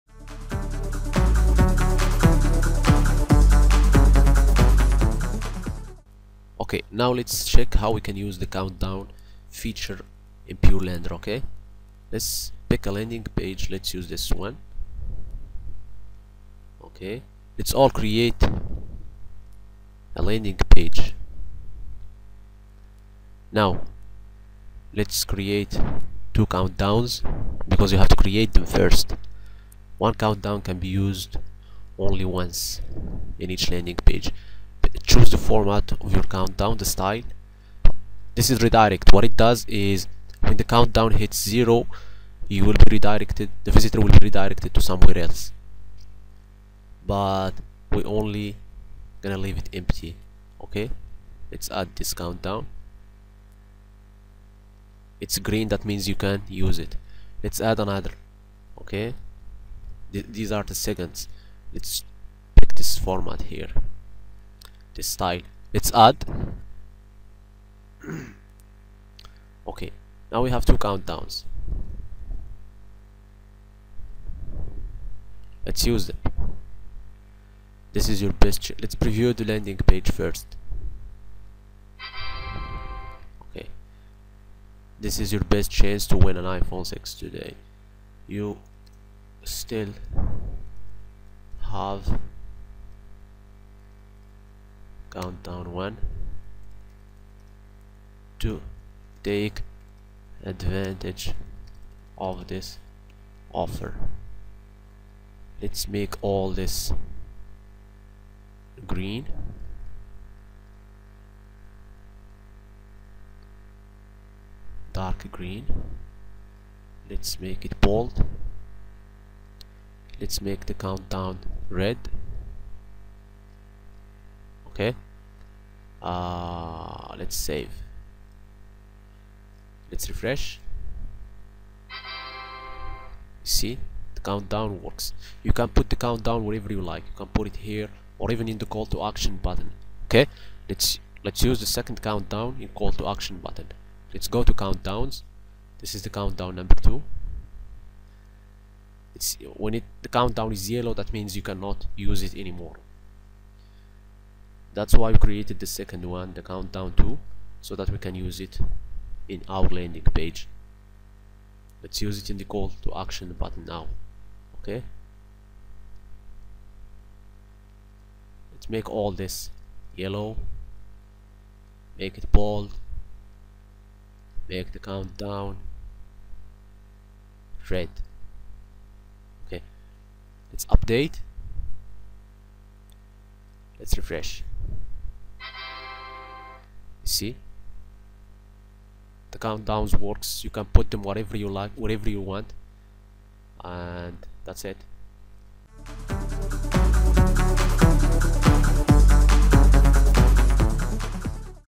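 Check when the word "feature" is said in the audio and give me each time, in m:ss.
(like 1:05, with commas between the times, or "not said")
0:09.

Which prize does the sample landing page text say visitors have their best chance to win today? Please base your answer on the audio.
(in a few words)
iPhone 6.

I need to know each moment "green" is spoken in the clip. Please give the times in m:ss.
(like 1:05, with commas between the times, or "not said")
0:55, 1:48, 1:55.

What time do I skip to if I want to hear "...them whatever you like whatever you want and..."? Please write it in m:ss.
3:10.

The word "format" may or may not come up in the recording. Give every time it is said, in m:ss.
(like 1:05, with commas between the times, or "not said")
0:35, 1:03.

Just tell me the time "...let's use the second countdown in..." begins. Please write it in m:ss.
2:21.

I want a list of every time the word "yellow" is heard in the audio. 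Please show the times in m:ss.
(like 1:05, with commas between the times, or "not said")
2:30, 2:49.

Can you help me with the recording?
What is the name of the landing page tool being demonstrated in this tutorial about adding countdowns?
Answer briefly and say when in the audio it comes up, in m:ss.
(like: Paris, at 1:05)
Purelander, at 0:10.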